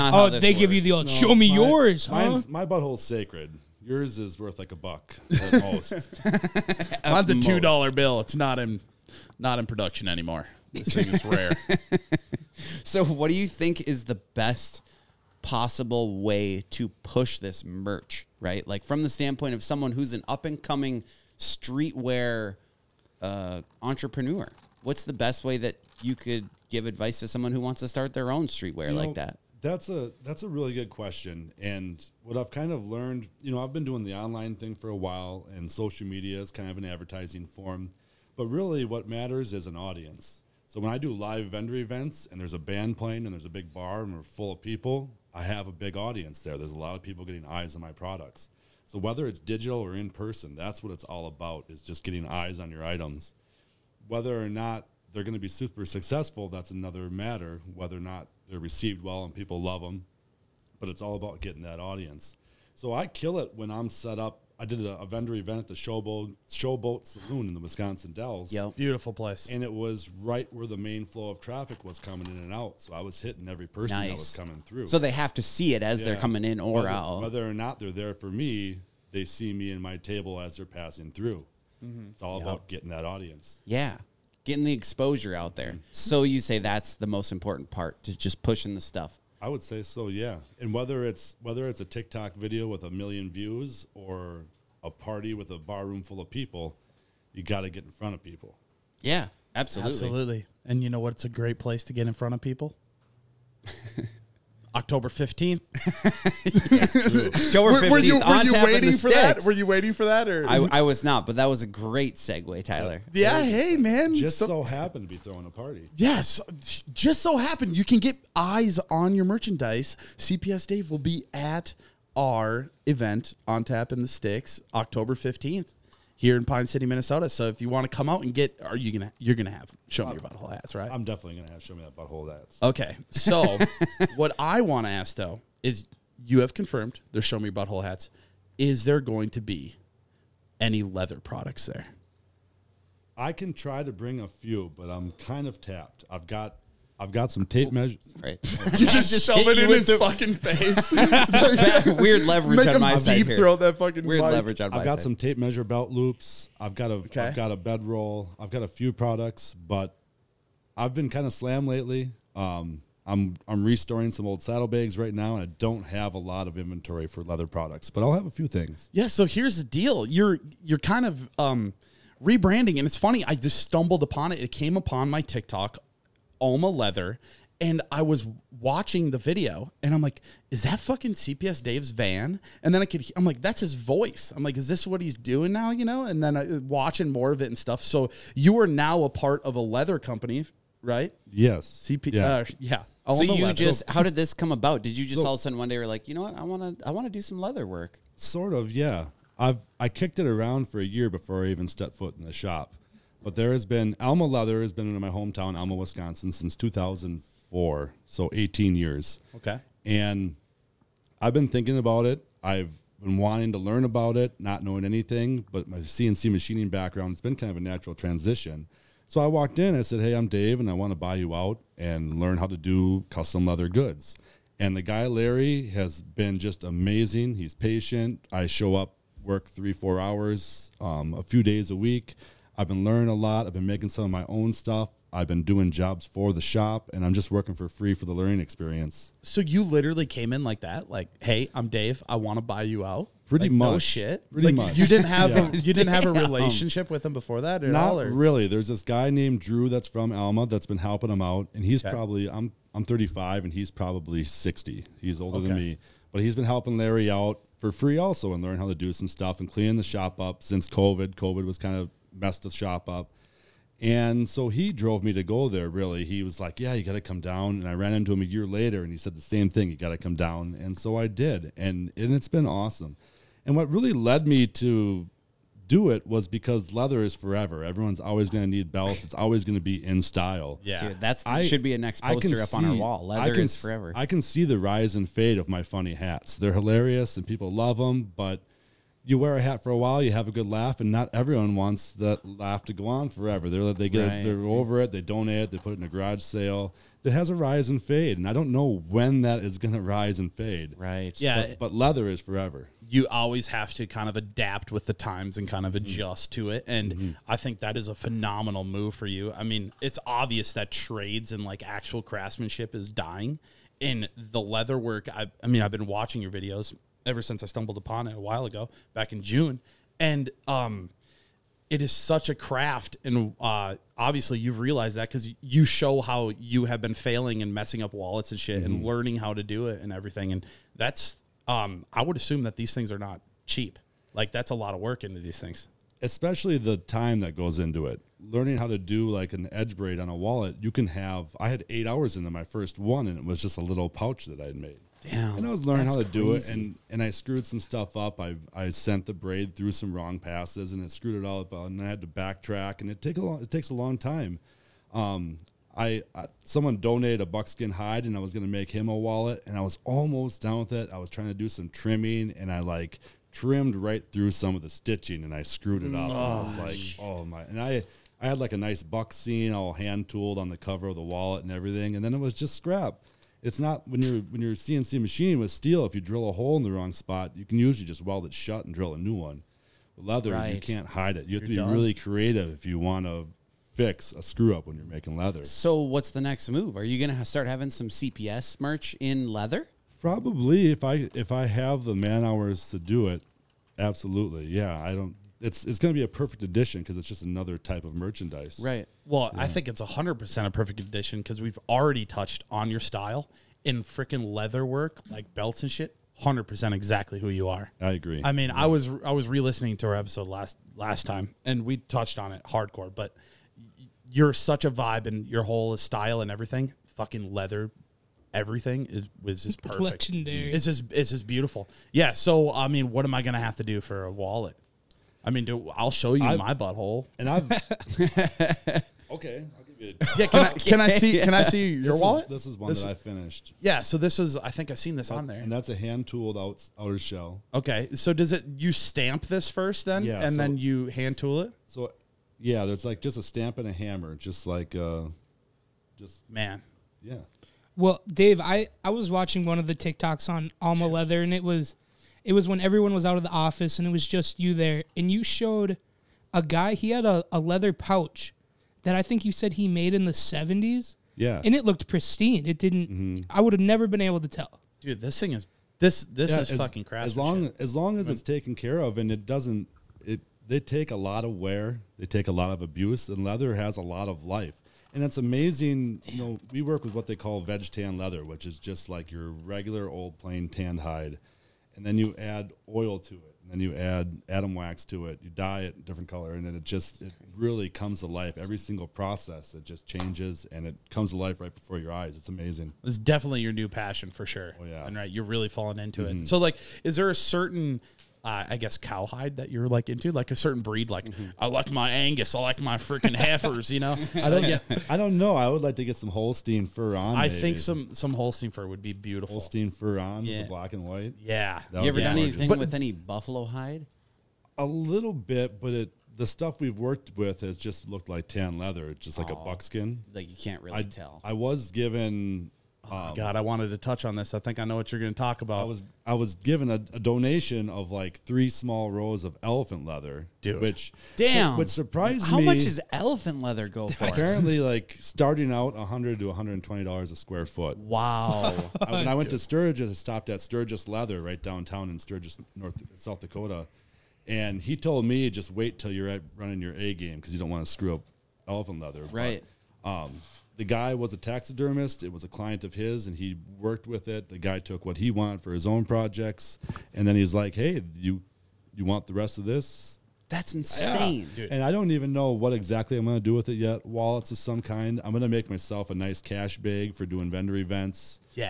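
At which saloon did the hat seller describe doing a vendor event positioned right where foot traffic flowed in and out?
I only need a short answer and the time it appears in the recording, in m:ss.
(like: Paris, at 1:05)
Showboat Saloon, at 1:06.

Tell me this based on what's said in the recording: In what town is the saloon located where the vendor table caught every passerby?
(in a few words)
Wisconsin Dells.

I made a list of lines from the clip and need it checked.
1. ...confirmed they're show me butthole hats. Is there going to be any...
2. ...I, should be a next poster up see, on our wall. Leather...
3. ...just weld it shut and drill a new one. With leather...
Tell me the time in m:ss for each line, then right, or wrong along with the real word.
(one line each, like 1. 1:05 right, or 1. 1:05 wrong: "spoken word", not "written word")
1. 2:16 right
2. 4:41 right
3. 6:17 right.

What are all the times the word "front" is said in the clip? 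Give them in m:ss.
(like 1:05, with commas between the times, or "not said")
1:37, 1:42.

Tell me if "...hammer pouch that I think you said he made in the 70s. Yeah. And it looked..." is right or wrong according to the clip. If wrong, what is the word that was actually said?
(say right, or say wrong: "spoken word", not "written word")
wrong: "leather", not "hammer".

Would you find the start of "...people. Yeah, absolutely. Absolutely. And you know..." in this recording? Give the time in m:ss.
1:38.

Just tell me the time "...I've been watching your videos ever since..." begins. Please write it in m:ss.
5:15.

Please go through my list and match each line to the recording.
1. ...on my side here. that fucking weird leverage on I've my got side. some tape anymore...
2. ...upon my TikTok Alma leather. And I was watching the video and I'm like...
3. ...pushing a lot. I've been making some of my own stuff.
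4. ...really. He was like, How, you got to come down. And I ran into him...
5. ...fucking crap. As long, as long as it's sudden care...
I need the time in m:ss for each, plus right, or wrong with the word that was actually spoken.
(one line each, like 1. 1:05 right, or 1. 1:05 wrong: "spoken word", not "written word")
1. 2:32 wrong: "measure", not "anymore"
2. 2:54 right
3. 3:52 wrong: "learning", not "pushing"
4. 4:25 wrong: "Yeah", not "How"
5. 7:46 wrong: "taken", not "sudden".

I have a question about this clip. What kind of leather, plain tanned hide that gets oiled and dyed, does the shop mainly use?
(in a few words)
veg tan.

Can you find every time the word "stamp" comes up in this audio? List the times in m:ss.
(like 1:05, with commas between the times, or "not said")
7:18, 7:23.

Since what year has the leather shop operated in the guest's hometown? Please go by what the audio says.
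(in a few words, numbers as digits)
2004.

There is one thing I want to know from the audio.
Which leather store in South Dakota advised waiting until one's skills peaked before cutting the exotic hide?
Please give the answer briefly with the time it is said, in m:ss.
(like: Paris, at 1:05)
Sturgis Leather, at 9:00.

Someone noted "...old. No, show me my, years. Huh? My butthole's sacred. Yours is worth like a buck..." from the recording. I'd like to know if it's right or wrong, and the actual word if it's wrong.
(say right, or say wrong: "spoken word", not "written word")
wrong: "yours", not "years".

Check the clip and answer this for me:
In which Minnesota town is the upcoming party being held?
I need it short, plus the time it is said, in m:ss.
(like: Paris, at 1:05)
Pine City, at 2:06.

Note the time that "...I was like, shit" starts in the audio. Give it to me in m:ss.
6:06.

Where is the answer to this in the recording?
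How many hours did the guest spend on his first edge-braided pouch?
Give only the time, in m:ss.
5:41.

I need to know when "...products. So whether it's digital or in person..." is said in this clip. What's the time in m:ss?
0:47.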